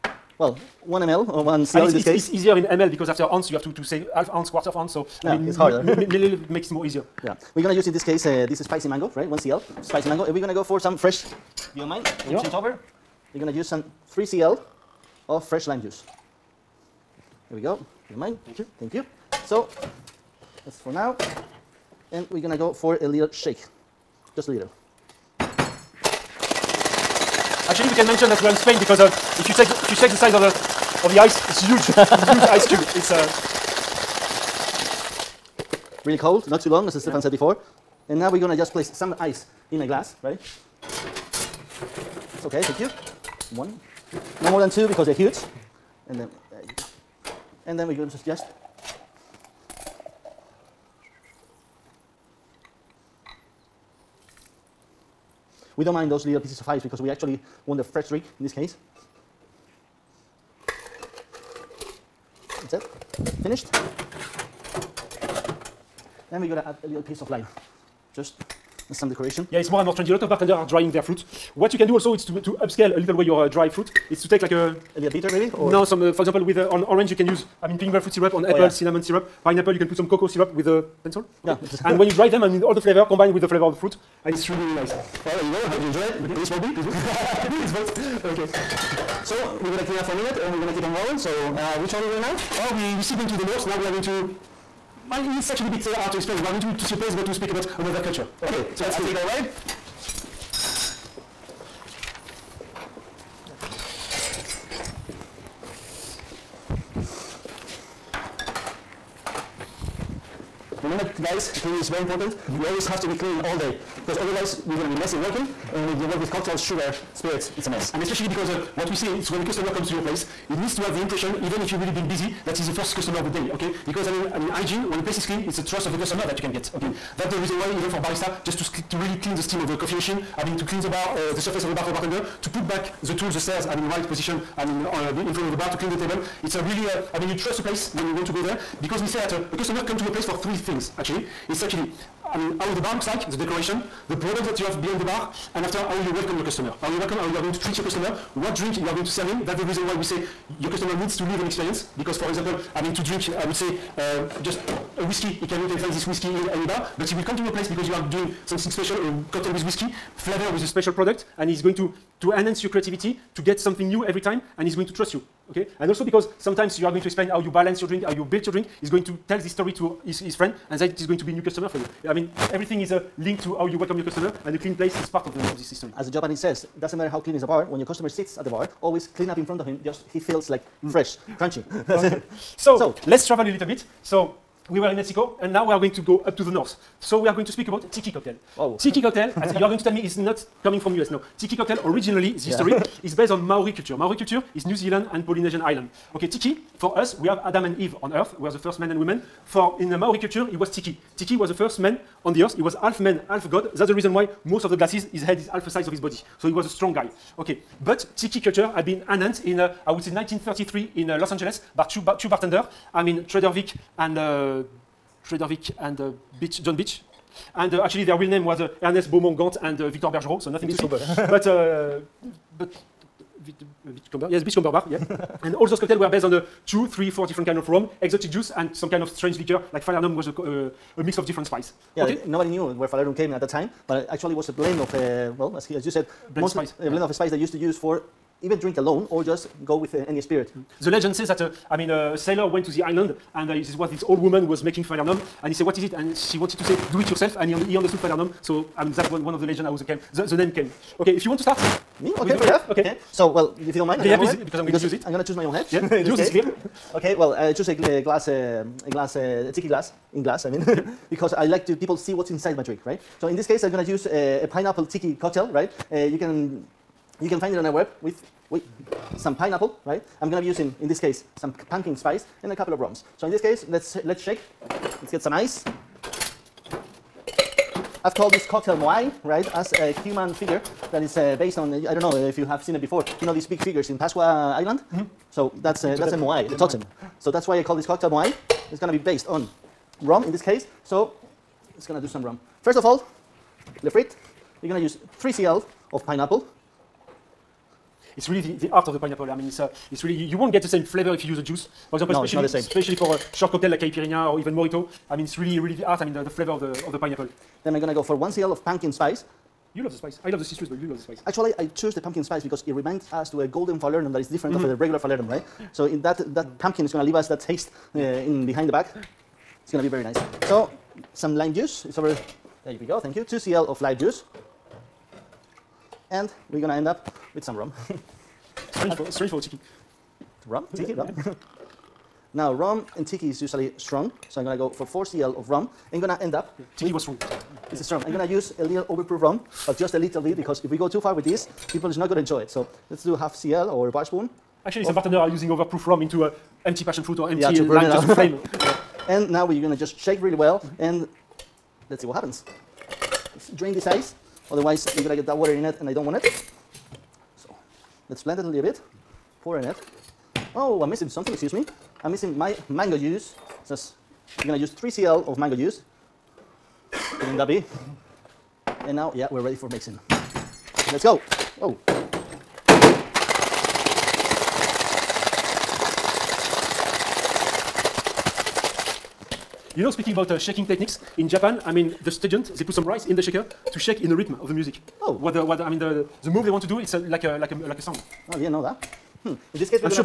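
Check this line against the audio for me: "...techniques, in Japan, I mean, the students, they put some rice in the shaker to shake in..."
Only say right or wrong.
right.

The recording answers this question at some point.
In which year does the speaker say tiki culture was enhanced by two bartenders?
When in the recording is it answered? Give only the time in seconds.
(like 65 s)
210 s.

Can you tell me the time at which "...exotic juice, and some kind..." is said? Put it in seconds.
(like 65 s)
228 s.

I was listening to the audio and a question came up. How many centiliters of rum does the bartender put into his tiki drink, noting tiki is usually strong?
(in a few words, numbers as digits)
4 cl.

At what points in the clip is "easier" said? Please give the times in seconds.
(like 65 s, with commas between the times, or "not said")
2 s, 6 s.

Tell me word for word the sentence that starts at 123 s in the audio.
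Because, I mean, I mean, hygiene, when the place is clean, it's the trust of the customer that you can get, okay?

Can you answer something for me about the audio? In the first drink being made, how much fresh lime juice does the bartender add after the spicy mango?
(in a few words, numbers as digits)
3 cl.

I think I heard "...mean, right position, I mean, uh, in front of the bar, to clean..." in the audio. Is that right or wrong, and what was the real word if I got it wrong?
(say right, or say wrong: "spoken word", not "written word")
right.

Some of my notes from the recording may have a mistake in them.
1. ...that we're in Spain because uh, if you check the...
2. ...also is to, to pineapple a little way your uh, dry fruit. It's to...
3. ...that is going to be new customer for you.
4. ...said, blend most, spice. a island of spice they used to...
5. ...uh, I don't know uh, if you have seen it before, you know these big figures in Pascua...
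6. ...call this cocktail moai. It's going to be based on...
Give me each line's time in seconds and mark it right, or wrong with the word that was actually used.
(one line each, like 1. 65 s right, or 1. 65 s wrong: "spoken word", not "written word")
1. 28 s right
2. 71 s wrong: "upscale", not "pineapple"
3. 170 s right
4. 235 s wrong: "blend", not "island"
5. 281 s right
6. 287 s right.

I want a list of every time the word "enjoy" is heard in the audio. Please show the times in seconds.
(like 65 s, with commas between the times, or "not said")
85 s, 342 s.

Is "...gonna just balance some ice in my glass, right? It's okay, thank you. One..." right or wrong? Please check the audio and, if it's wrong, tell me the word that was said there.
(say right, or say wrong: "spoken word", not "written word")
wrong: "place", not "balance".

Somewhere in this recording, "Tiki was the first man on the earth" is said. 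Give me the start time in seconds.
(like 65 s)
201 s.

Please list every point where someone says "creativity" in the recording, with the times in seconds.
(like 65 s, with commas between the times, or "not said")
162 s.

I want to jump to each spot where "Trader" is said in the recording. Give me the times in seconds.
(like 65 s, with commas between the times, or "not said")
213 s.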